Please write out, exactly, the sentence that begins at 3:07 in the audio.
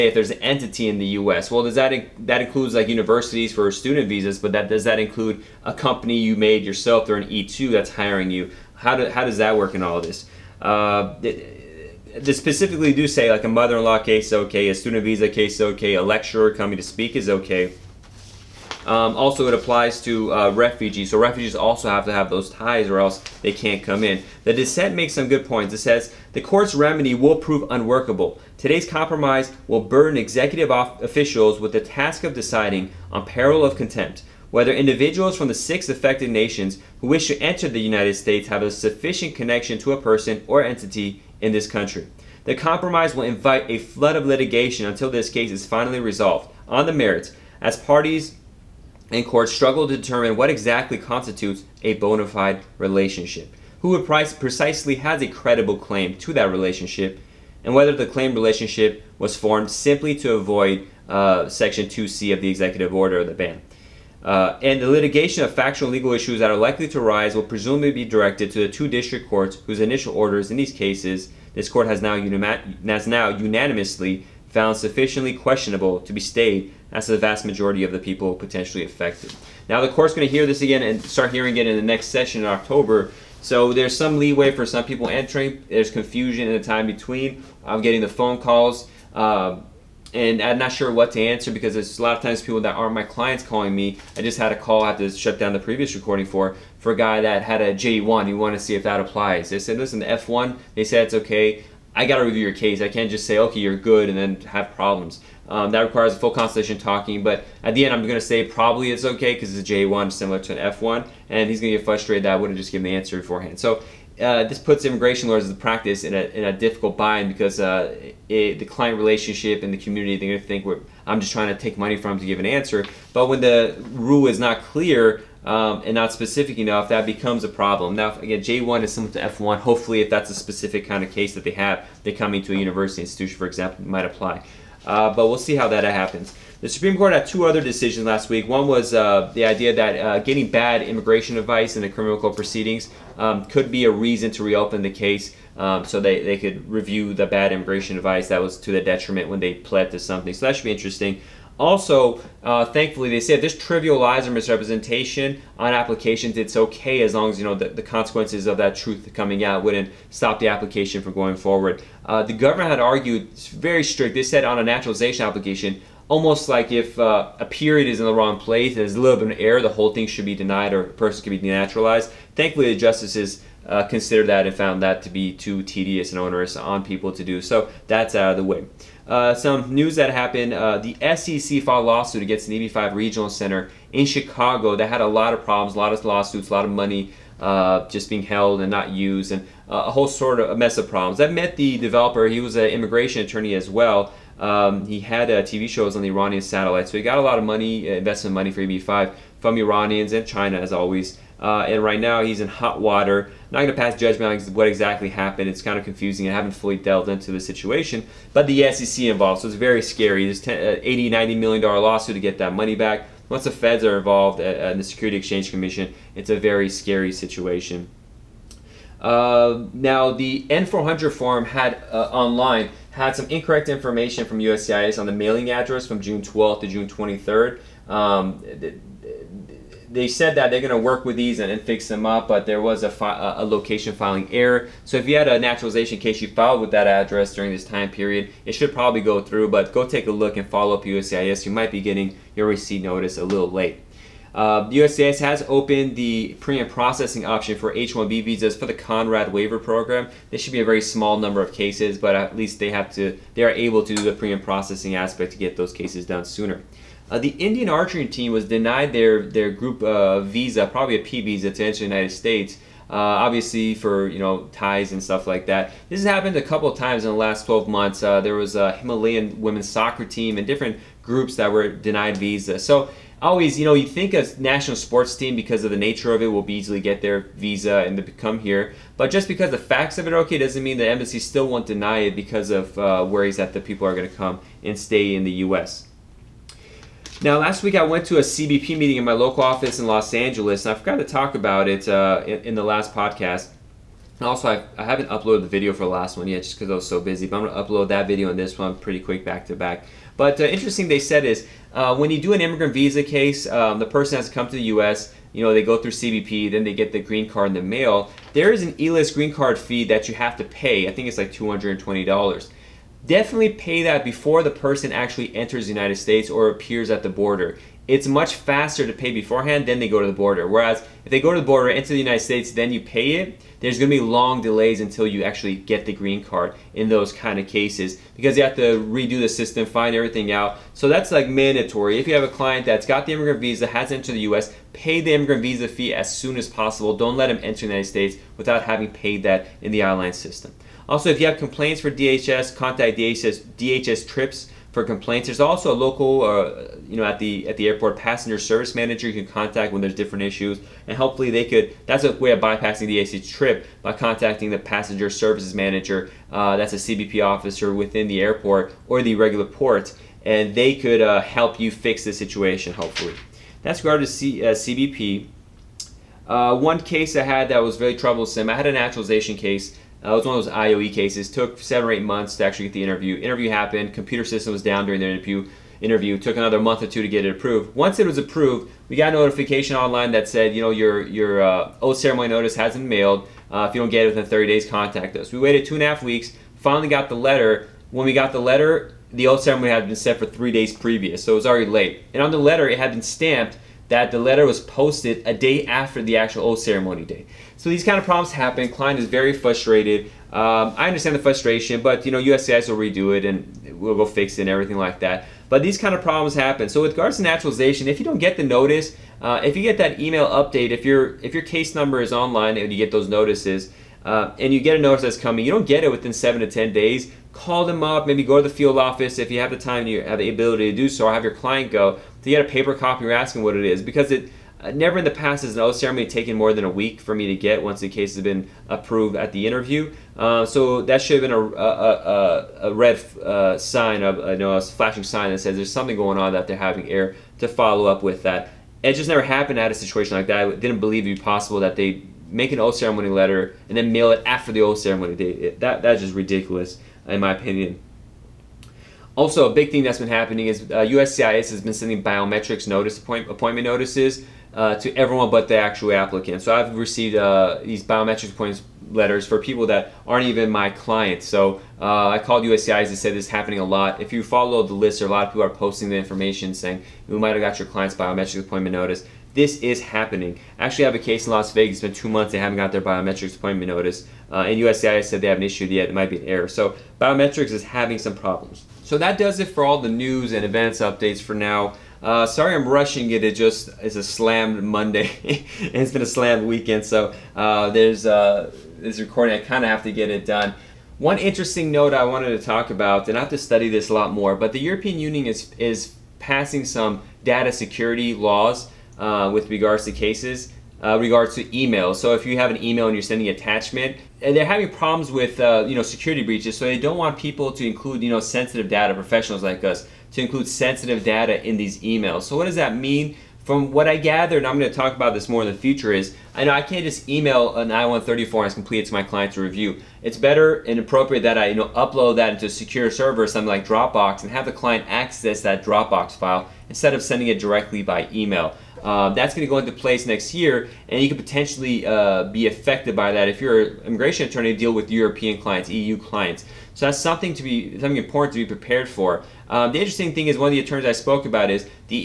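Uh, just being held and not used, and uh, a whole sort of mess of problems.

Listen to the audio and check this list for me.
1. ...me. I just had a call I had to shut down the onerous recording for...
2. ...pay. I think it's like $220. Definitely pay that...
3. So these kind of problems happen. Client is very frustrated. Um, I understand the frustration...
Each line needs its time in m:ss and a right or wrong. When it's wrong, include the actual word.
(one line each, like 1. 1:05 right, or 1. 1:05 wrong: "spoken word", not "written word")
1. 1:33 wrong: "previous", not "onerous"
2. 5:10 right
3. 6:37 right.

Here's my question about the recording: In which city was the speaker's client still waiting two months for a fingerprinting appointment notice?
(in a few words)
Las Vegas.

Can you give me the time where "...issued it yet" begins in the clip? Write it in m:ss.
7:55.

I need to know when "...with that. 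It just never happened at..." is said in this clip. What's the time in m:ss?
7:18.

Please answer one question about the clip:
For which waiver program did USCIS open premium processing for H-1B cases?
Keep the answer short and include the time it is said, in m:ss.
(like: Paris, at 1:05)
Conrad waiver program, at 4:08.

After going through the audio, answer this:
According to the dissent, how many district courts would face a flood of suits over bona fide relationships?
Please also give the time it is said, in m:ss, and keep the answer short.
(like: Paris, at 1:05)
2, at 1:08.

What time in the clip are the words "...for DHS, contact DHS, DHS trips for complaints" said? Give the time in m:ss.
5:41.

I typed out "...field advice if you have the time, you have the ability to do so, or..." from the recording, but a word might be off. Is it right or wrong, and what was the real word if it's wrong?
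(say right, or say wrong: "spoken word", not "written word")
wrong: "office", not "advice".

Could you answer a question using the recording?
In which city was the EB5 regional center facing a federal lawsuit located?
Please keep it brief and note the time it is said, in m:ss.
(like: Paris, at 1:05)
Chicago, at 3:04.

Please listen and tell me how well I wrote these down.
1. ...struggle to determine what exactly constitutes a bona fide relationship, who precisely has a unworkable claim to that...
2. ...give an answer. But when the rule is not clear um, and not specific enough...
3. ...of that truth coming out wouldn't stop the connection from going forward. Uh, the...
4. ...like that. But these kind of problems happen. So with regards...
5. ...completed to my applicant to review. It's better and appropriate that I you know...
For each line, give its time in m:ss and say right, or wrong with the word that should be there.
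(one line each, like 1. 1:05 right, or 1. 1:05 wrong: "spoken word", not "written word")
1. 0:49 wrong: "credible", not "unworkable"
2. 2:02 right
3. 2:38 wrong: "application", not "connection"
4. 6:44 right
5. 8:38 wrong: "client", not "applicant".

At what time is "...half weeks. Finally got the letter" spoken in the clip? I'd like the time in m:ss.
6:25.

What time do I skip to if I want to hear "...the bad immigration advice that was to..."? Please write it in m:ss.
2:27.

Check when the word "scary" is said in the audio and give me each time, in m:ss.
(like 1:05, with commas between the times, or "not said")
3:29, 3:36.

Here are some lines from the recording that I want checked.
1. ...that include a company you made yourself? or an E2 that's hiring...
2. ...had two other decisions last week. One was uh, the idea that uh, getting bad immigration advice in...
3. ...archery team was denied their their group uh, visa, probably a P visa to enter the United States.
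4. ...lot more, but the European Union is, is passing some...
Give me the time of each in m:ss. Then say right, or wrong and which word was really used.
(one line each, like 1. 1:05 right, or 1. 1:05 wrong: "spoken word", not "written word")
1. 0:04 right
2. 2:17 right
3. 4:17 right
4. 8:13 right.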